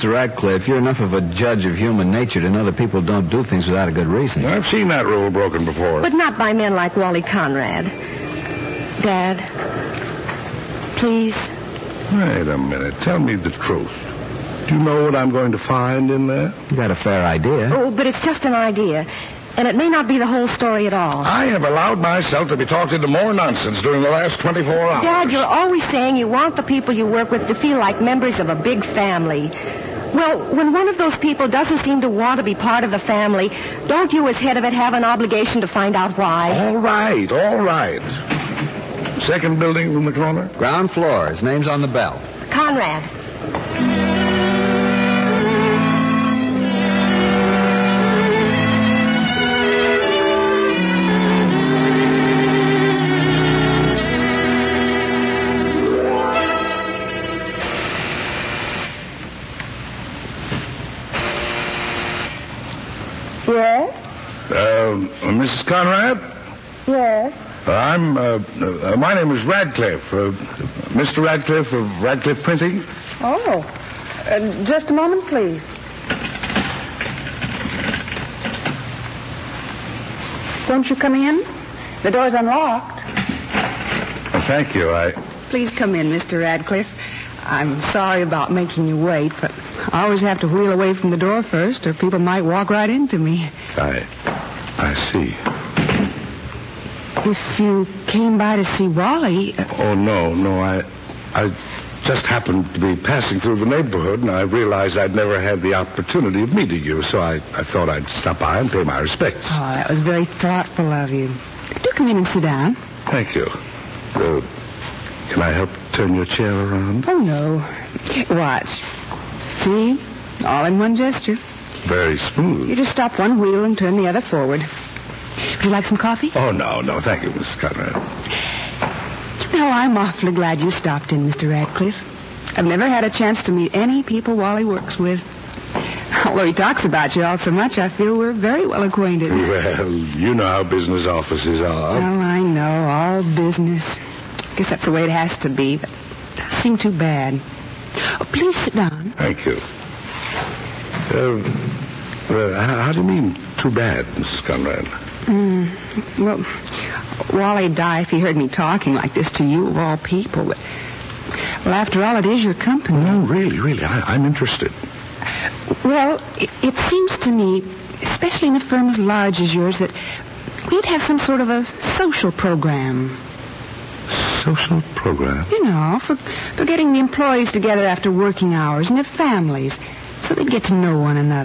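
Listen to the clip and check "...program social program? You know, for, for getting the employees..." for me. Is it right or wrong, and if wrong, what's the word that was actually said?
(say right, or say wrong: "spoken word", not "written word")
right.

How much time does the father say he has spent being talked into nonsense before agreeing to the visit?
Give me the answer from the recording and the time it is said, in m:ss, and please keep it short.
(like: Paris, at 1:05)
24 hours, at 0:24.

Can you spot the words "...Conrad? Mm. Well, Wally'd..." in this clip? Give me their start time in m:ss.
2:34.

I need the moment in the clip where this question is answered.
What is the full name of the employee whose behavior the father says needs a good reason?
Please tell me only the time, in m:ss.
0:06.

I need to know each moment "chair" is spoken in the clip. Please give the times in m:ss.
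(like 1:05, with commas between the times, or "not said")
1:56.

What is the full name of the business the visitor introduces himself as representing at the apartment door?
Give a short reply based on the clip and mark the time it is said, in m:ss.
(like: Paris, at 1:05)
Radcliffe Printing, at 1:12.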